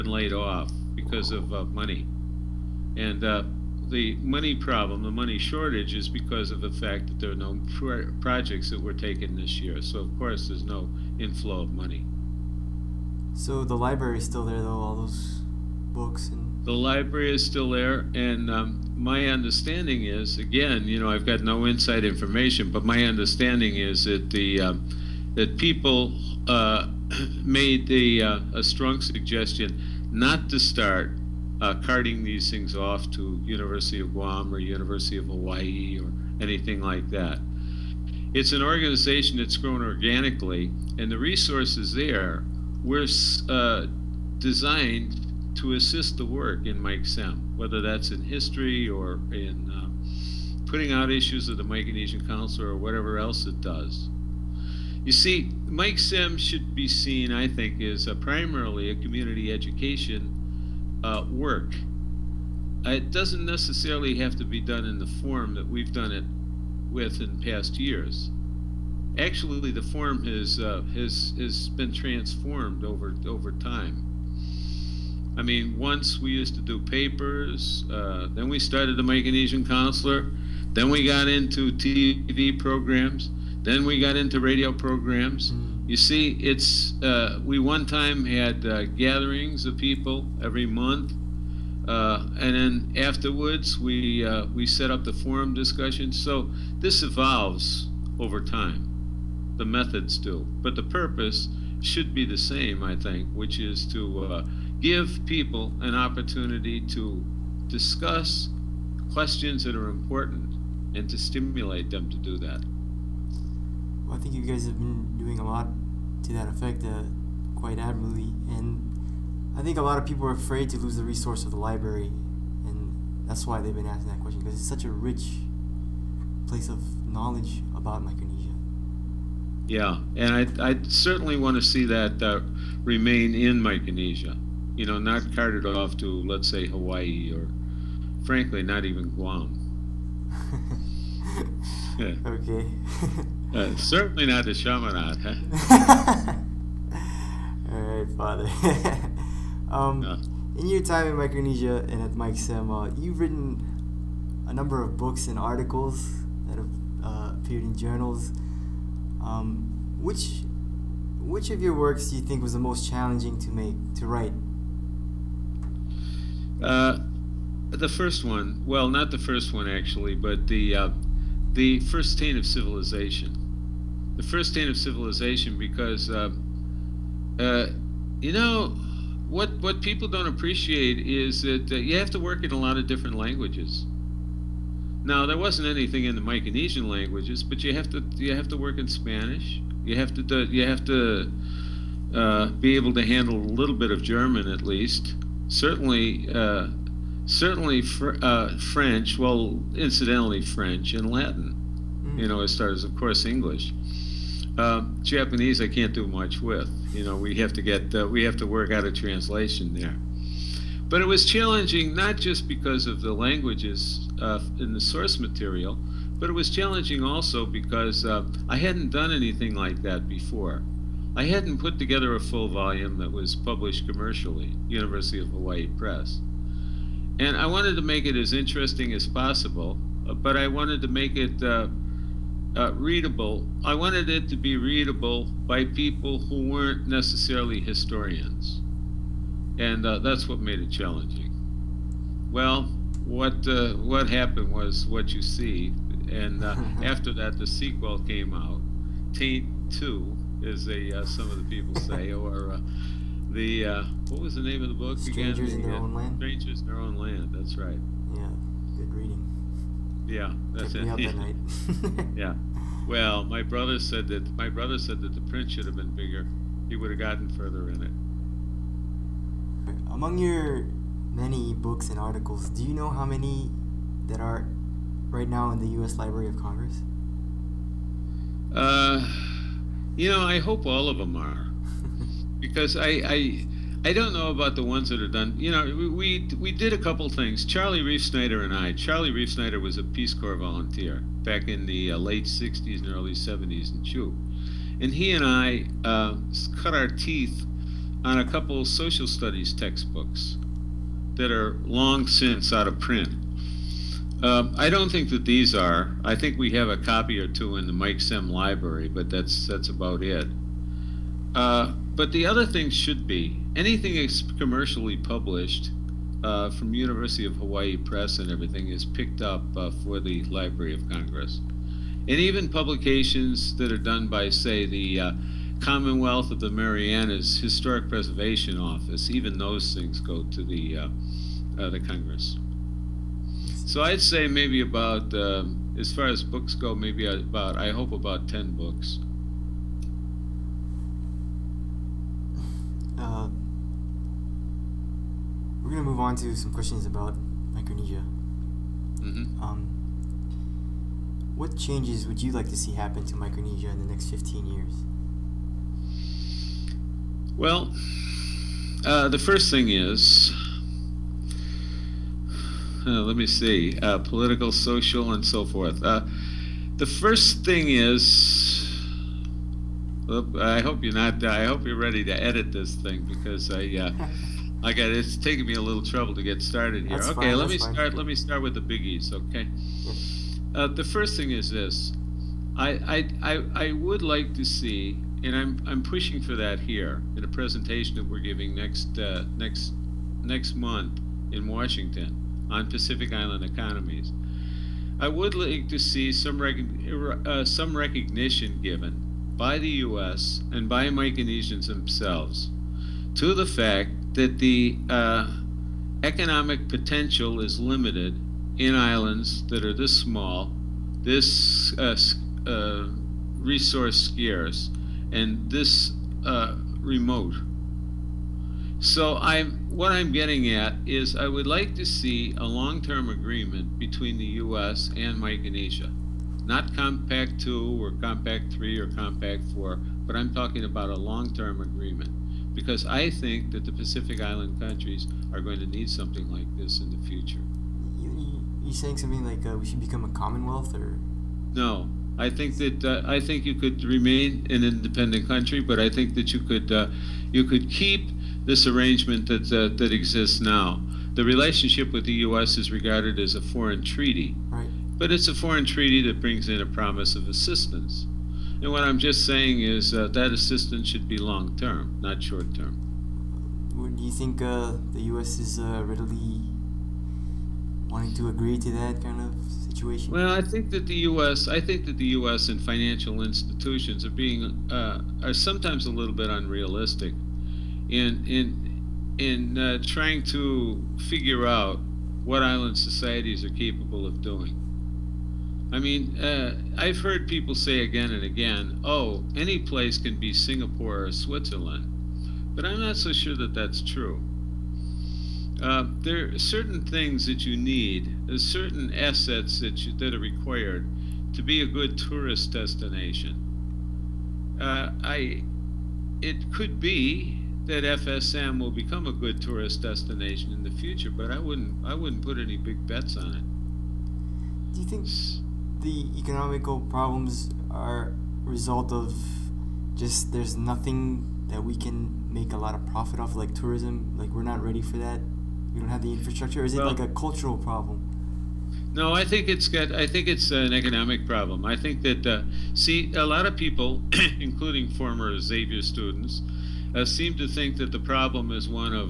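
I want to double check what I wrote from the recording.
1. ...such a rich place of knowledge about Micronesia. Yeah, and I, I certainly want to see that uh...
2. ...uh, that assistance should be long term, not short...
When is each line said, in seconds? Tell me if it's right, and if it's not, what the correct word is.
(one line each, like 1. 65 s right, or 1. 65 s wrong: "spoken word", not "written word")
1. 124 s right
2. 459 s right.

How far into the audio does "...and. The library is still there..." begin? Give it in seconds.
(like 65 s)
16 s.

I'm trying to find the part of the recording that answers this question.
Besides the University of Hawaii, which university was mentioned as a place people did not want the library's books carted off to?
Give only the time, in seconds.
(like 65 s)
33 s.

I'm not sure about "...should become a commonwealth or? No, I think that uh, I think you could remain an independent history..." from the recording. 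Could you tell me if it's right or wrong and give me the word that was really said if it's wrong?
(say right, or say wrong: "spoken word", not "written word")
wrong: "country", not "history".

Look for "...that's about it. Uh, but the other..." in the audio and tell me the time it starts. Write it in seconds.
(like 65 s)
309 s.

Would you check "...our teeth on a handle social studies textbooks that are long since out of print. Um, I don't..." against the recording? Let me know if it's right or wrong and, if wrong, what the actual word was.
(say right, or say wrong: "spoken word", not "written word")
wrong: "couple", not "handle".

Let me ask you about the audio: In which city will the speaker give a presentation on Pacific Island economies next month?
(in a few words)
Washington.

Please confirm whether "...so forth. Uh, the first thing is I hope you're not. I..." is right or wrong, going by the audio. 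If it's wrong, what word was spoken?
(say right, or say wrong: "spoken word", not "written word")
right.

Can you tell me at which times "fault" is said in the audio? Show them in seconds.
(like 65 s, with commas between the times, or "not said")
not said.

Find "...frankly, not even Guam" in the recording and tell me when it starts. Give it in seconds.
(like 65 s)
138 s.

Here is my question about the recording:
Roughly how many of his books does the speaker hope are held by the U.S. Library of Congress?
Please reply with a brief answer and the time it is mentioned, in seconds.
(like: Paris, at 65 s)
10, at 338 s.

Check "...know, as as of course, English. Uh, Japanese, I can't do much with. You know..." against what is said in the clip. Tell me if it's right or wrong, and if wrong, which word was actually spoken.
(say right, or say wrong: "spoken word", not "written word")
right.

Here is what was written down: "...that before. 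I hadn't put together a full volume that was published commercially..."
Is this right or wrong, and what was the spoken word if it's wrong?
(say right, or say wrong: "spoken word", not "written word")
right.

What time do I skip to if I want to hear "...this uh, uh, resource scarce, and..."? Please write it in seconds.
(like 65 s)
411 s.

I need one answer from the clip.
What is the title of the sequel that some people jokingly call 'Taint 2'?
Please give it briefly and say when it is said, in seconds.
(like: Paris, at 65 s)
Strangers in Their Own Land, at 256 s.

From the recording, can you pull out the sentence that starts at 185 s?
Now, there wasn't anything in the Micronesian languages, but you have to, you have to work in Spanish.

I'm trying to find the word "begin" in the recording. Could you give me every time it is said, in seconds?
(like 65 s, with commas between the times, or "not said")
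not said.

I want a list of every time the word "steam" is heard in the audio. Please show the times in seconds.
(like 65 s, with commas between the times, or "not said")
not said.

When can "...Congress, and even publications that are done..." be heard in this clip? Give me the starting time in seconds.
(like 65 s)
320 s.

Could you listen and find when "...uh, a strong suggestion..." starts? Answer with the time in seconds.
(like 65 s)
28 s.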